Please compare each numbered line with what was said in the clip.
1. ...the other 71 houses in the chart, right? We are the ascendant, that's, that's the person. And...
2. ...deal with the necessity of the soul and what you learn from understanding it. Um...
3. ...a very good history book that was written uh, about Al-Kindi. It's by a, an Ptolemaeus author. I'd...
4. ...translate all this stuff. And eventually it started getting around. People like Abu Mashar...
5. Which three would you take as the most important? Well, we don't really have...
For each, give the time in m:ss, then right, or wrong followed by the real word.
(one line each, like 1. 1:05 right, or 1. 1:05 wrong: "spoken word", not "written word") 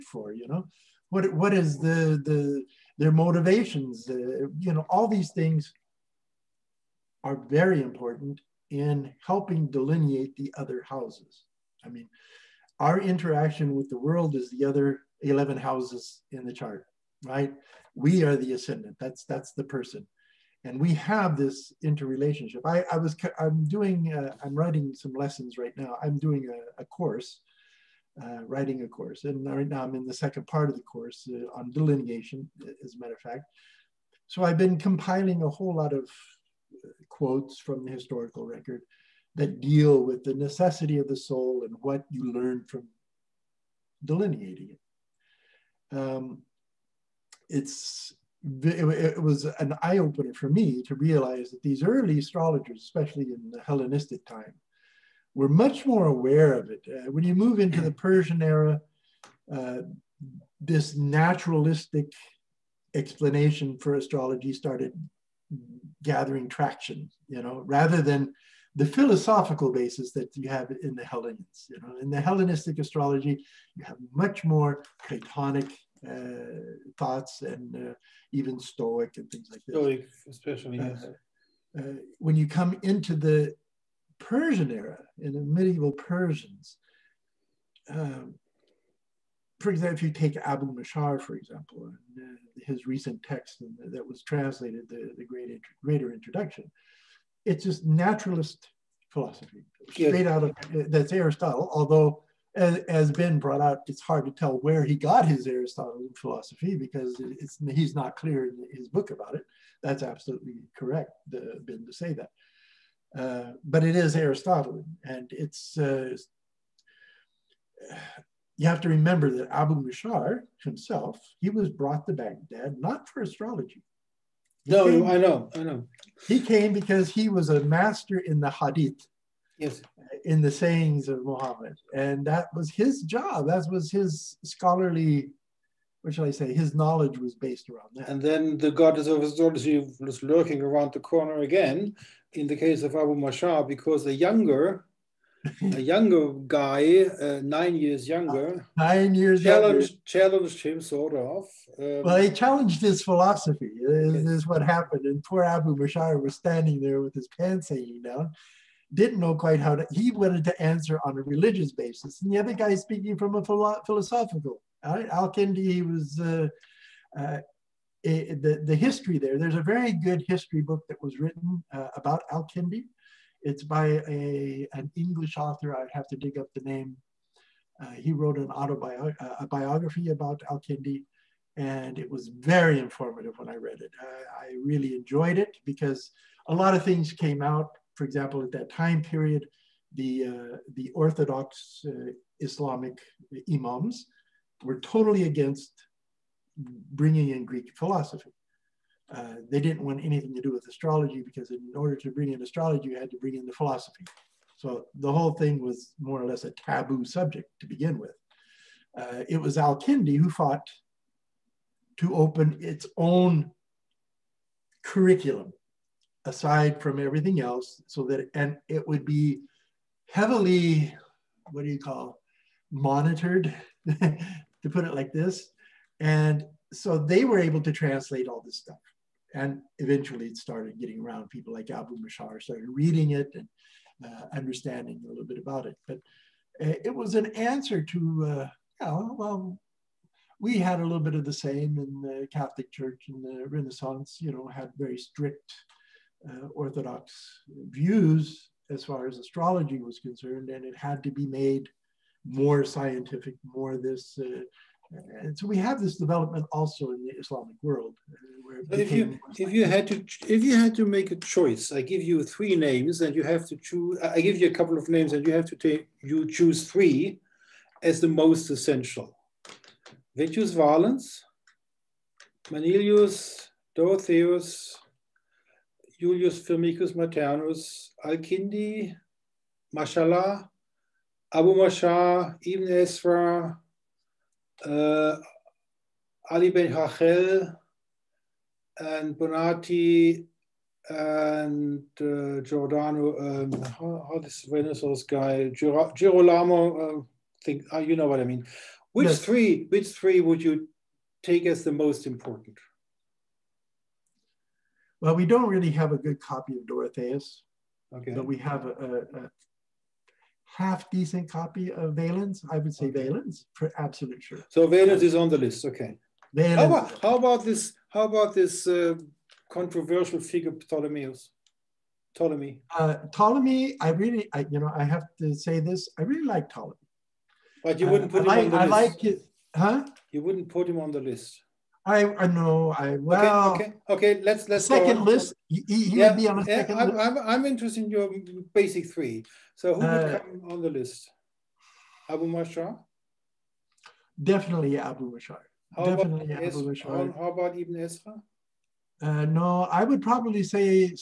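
1. 0:14 wrong: "11", not "71"
2. 0:39 wrong: "delineating", not "understanding"
3. 2:49 wrong: "English", not "Ptolemaeus"
4. 3:47 right
5. 4:59 right.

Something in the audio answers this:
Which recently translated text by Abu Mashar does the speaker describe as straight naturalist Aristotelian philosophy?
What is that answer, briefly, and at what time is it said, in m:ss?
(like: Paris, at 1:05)
Greater Introduction, at 1:35.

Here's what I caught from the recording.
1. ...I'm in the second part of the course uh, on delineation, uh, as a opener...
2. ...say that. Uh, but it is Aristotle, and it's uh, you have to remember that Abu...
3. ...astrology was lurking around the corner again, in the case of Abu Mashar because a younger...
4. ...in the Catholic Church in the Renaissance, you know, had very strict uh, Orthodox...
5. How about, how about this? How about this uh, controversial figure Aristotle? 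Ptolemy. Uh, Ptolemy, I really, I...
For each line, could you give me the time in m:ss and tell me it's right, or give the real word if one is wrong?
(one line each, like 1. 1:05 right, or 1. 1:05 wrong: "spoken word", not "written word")
1. 0:29 wrong: "matter", not "opener"
2. 1:51 right
3. 2:19 right
4. 4:01 right
5. 5:16 wrong: "Ptolemaeus", not "Aristotle".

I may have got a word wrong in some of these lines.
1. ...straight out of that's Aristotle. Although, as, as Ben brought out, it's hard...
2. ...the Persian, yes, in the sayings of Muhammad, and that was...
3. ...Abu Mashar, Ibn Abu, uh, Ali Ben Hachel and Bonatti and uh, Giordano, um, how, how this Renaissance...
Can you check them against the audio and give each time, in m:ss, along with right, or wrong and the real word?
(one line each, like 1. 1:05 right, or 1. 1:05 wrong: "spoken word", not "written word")
1. 1:39 right
2. 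2:08 wrong: "Hadith", not "Persian"
3. 4:41 wrong: "Ezra", not "Abu".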